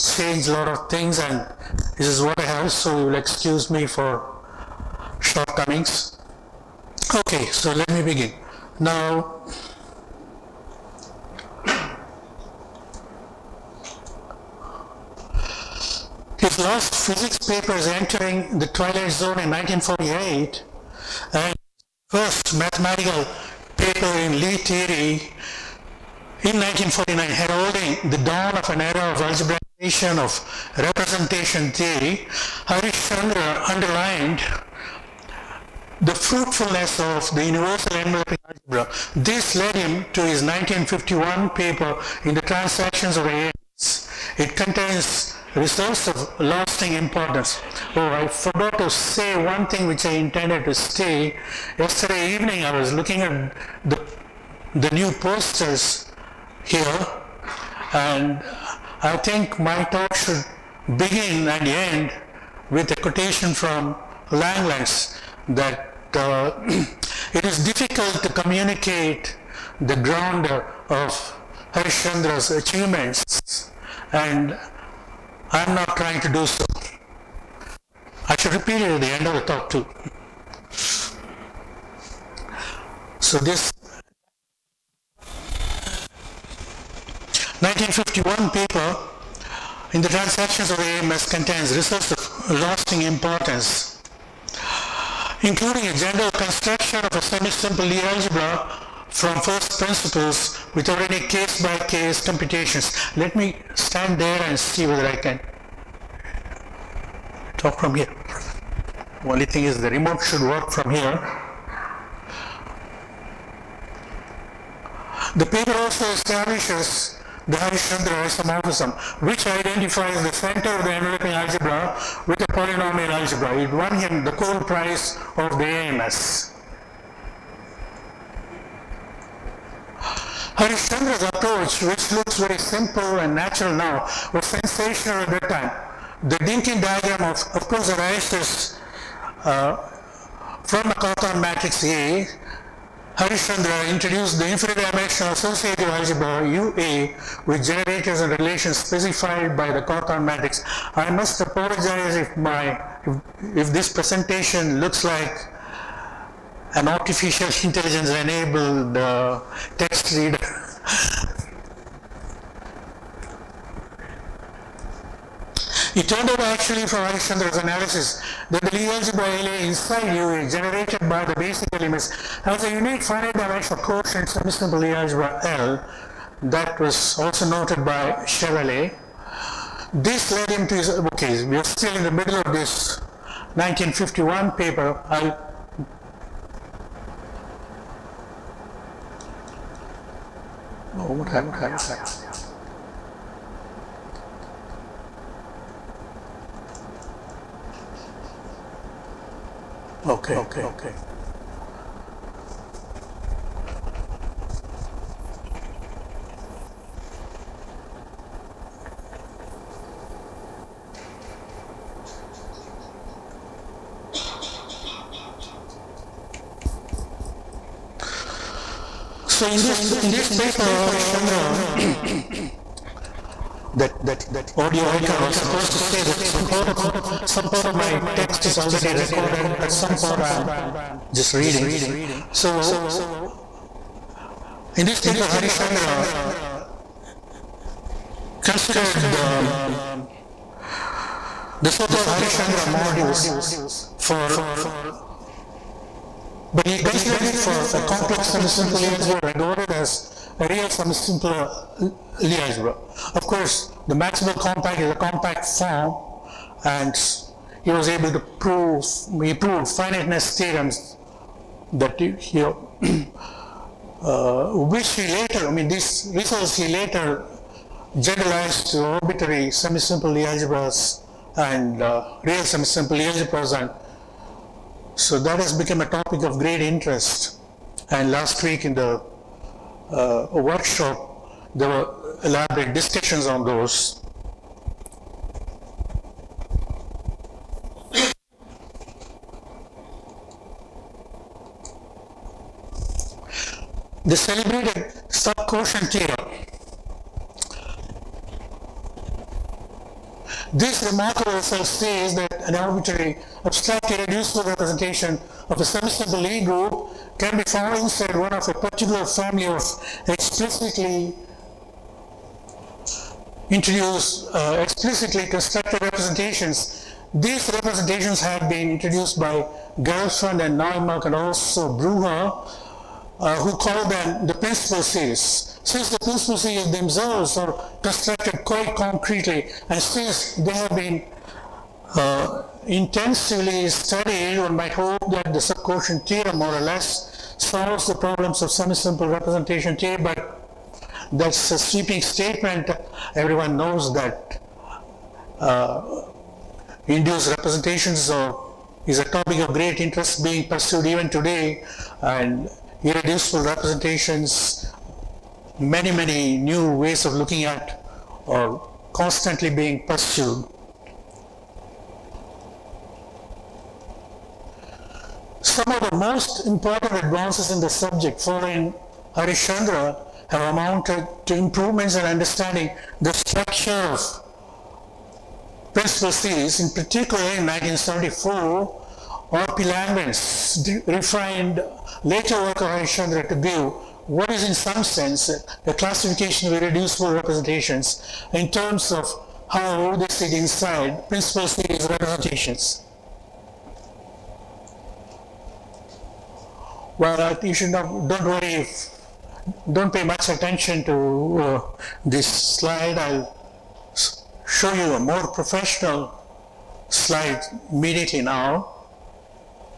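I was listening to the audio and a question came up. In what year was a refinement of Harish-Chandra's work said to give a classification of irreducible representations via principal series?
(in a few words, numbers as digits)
1974.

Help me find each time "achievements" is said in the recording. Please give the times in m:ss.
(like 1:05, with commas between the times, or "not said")
1:12.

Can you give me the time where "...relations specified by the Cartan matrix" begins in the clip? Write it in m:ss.
2:28.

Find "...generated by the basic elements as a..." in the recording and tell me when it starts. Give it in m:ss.
2:50.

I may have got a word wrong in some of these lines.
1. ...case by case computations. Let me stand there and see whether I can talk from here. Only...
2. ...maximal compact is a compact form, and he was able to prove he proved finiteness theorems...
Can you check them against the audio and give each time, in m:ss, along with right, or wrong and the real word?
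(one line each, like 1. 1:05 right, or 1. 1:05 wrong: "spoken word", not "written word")
1. 1:41 right
2. 4:13 right.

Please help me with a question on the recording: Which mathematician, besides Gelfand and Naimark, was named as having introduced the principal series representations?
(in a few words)
Bruhat.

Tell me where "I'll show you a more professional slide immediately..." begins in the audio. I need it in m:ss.
6:42.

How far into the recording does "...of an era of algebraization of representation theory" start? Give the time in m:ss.
0:28.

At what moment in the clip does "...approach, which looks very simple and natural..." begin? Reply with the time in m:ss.
2:11.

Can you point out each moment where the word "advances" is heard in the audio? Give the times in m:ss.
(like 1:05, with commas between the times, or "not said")
6:06.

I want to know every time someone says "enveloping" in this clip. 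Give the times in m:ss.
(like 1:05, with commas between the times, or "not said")
0:37, 2:00.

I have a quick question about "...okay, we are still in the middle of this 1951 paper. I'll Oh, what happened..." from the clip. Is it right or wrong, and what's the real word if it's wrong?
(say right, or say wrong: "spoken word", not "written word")
right.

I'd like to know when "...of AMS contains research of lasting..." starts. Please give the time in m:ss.
1:30.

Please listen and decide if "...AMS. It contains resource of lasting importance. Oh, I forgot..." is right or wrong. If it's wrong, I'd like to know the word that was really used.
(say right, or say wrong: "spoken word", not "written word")
right.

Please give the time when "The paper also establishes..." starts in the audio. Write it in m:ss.
1:55.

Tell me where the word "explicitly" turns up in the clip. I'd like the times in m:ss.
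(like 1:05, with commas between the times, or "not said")
5:10, 5:14.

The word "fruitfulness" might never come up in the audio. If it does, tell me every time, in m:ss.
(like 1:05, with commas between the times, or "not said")
0:36.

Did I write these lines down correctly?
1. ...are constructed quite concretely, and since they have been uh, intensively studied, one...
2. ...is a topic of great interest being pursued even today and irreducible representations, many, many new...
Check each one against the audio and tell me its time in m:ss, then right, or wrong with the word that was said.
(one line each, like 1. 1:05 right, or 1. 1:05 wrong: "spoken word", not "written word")
1. 5:27 right
2. 5:48 right.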